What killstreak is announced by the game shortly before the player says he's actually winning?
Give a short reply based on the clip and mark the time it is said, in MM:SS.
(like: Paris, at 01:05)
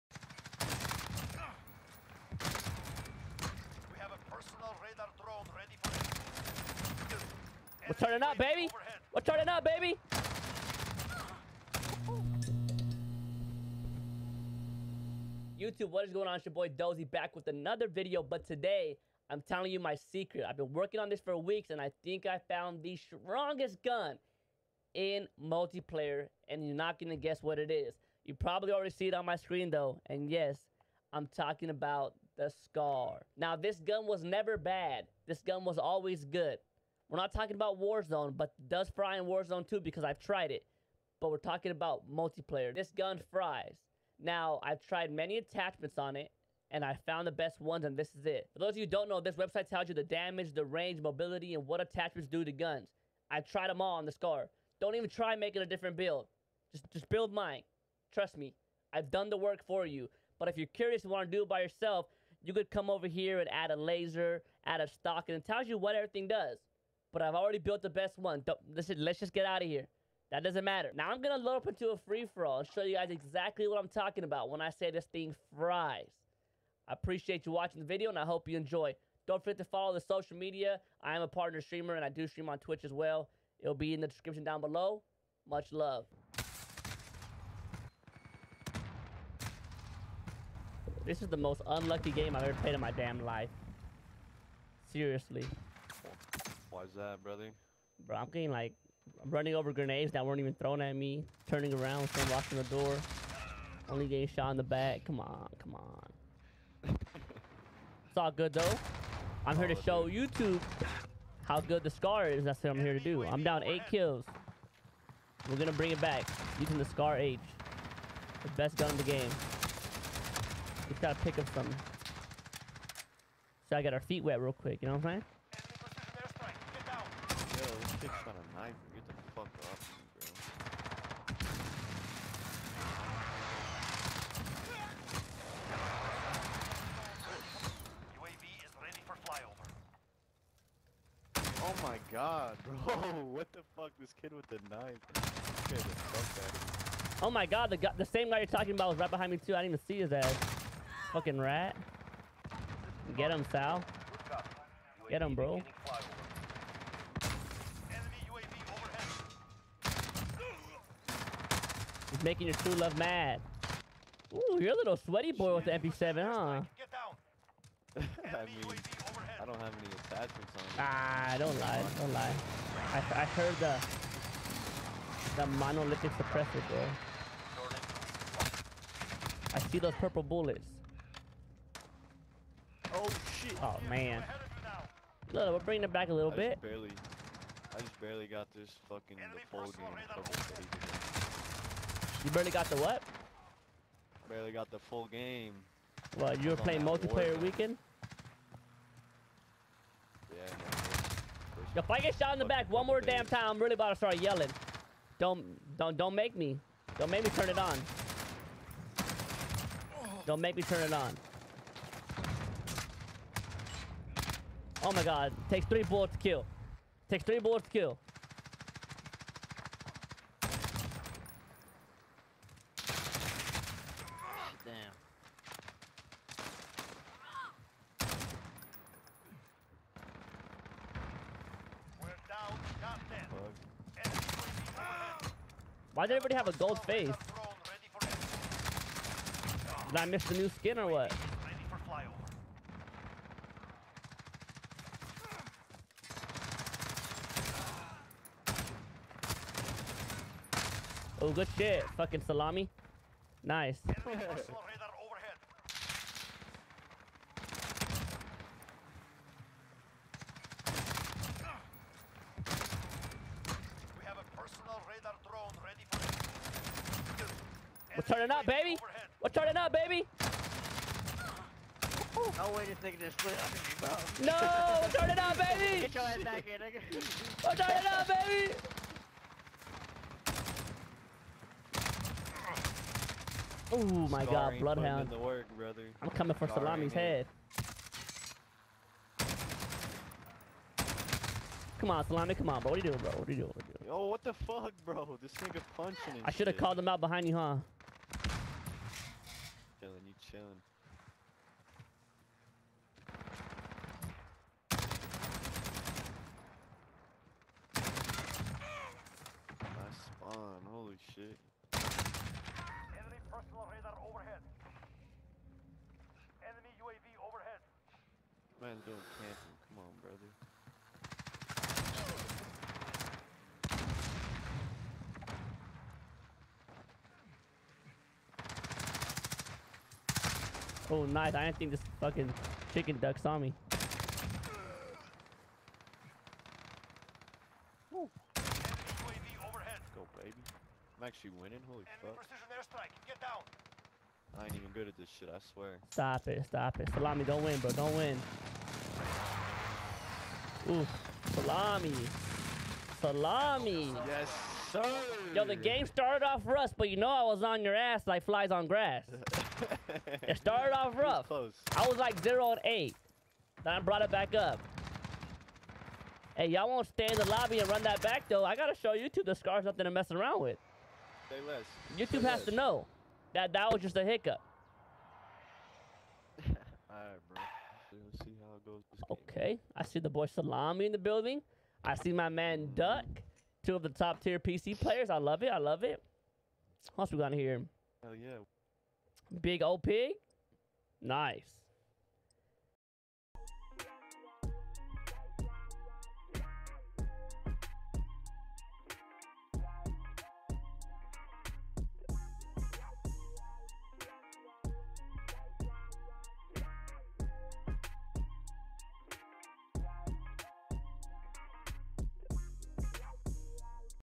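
Precision airstrike, at 05:42.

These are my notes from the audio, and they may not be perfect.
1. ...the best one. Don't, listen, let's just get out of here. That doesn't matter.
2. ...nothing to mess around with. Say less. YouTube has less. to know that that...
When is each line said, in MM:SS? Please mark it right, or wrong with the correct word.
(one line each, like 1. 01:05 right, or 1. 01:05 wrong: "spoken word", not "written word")
1. 01:07 right
2. 06:09 right.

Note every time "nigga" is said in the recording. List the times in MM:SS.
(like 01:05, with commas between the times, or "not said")
04:32, 04:55.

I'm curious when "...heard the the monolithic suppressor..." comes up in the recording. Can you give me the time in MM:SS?
02:53.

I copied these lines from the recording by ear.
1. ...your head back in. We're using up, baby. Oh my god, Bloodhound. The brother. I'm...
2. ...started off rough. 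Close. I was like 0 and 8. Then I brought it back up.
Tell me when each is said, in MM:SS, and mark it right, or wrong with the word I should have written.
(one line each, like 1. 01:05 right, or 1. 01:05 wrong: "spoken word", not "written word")
1. 04:35 wrong: "turning", not "using"
2. 06:00 right.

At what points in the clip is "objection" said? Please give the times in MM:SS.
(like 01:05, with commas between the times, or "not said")
not said.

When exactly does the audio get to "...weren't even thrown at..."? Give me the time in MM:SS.
01:40.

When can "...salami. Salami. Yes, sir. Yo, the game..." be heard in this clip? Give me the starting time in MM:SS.
05:51.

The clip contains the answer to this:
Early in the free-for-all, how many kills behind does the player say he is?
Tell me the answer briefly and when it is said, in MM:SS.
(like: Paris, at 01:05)
8, at 01:53.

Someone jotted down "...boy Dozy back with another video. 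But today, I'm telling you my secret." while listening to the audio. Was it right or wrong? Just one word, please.
right.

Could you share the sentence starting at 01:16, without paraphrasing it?
I appreciate you watching the video and I hope you enjoy.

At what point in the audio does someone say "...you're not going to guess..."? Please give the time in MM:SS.
00:26.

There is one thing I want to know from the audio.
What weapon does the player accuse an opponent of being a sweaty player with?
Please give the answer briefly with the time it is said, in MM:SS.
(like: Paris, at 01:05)
MP7, at 02:45.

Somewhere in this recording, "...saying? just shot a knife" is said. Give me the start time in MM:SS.
02:05.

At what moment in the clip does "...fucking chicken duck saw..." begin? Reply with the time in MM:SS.
05:32.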